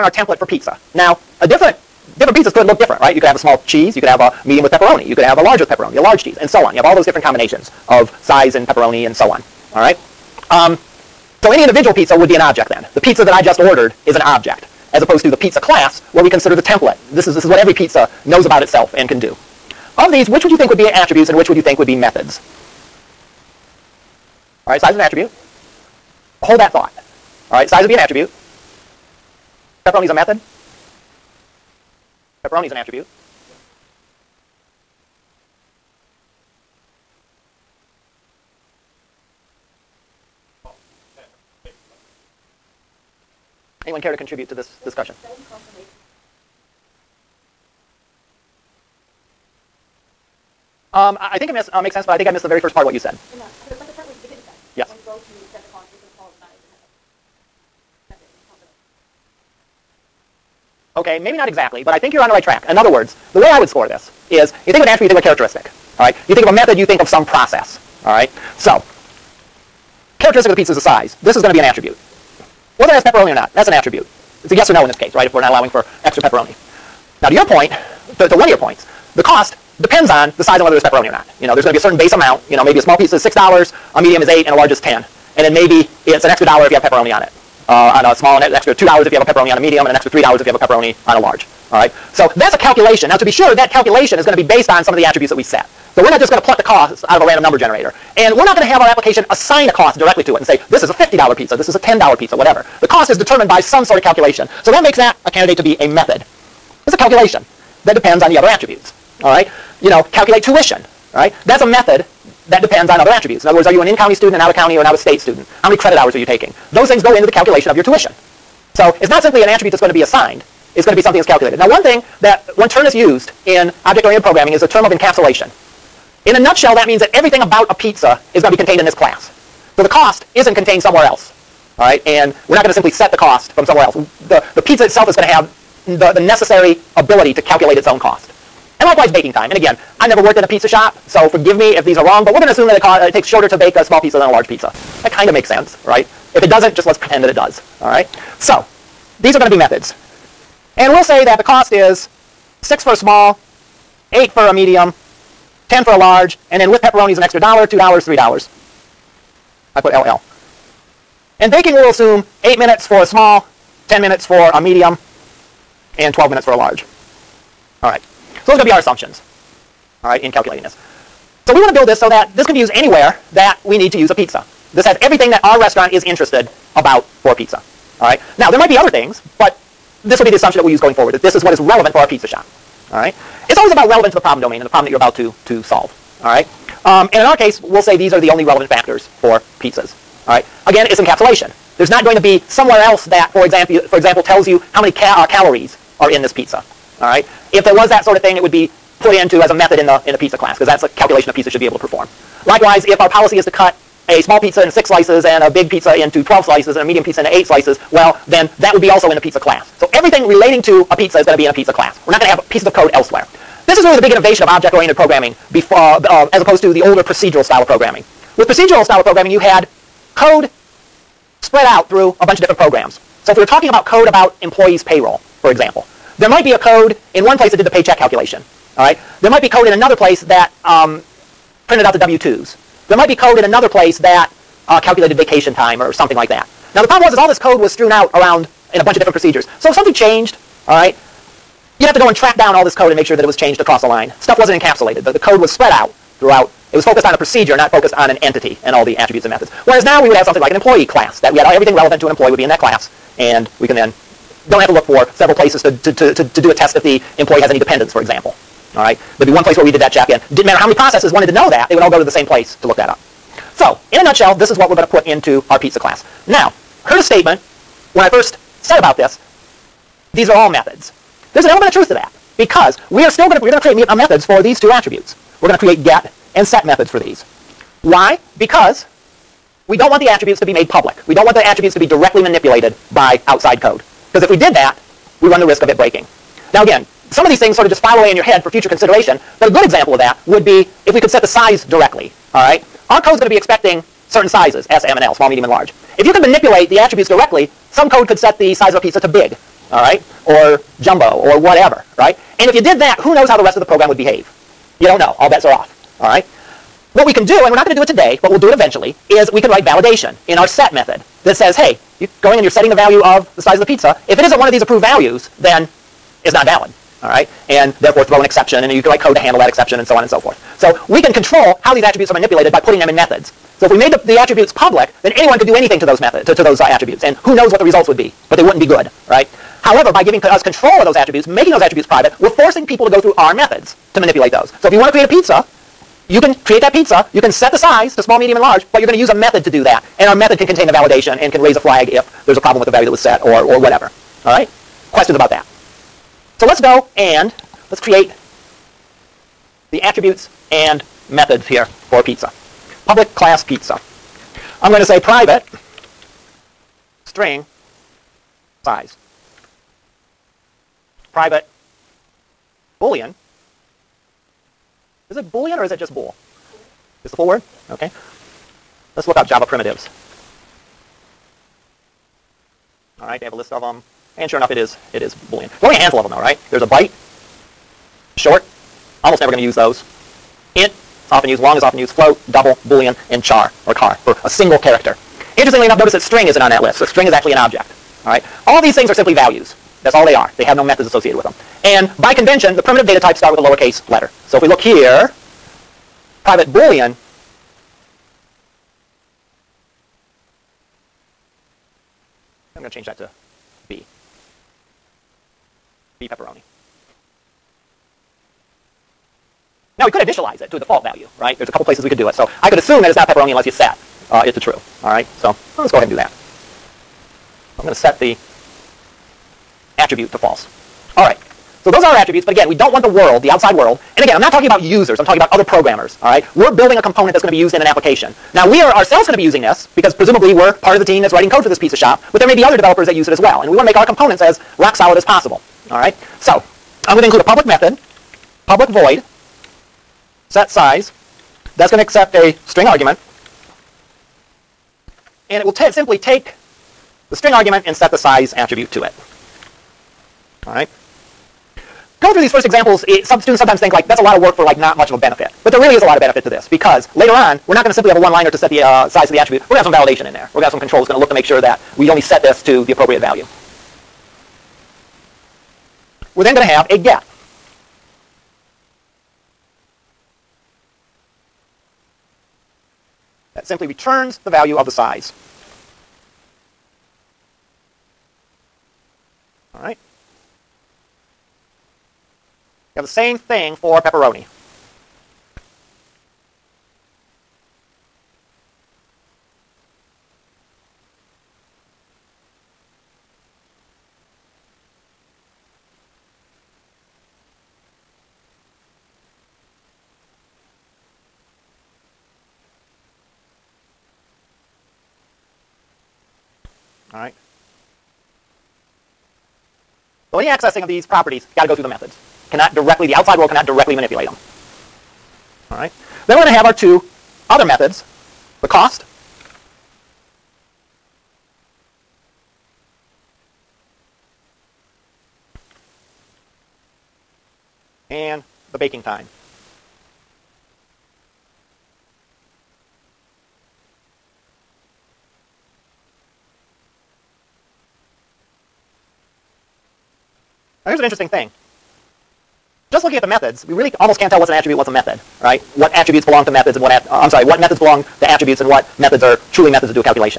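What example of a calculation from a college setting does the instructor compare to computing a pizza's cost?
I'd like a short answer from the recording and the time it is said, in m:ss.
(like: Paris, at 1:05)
calculate tuition, at 1:50.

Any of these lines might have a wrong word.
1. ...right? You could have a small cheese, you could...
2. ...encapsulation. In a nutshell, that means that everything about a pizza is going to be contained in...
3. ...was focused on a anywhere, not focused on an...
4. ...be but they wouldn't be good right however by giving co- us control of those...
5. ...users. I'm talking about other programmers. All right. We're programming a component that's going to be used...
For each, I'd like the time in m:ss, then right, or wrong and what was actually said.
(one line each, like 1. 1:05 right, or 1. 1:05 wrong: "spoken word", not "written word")
1. 0:02 right
2. 2:04 right
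3. 4:06 wrong: "procedure", not "anywhere"
4. 5:27 right
5. 7:04 wrong: "building", not "programming".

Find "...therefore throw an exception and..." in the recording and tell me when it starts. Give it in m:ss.
5:17.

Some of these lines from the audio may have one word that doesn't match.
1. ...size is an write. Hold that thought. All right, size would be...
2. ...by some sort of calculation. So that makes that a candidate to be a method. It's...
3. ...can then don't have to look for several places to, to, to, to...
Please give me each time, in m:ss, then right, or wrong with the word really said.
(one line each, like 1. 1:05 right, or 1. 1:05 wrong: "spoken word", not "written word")
1. 0:24 wrong: "attribute", not "write"
2. 1:43 right
3. 4:13 right.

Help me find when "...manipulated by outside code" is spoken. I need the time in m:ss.
4:42.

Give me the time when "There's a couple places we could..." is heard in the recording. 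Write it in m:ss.
6:51.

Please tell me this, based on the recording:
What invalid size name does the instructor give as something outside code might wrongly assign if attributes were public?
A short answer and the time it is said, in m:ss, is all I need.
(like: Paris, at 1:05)
jumbo, at 5:00.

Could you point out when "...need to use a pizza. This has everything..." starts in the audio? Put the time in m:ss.
2:53.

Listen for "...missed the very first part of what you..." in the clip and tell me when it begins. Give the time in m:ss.
0:52.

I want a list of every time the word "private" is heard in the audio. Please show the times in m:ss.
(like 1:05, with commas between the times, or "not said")
5:31, 5:54, 6:01, 6:36.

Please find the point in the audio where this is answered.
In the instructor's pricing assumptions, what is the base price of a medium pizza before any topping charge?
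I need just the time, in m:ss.
1:23.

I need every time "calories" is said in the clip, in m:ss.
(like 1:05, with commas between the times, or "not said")
3:15.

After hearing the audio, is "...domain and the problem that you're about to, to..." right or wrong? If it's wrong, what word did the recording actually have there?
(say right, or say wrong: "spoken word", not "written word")
right.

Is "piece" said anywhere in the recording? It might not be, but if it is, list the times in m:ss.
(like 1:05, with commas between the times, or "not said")
1:22, 3:32.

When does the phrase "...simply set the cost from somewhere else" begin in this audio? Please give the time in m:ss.
2:12.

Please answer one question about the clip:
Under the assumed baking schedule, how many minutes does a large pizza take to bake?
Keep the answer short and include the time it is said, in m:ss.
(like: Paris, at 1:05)
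12 minutes, at 2:46.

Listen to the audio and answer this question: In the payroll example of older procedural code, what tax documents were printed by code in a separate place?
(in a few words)
W-2s.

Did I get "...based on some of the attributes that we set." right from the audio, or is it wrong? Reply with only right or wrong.
right.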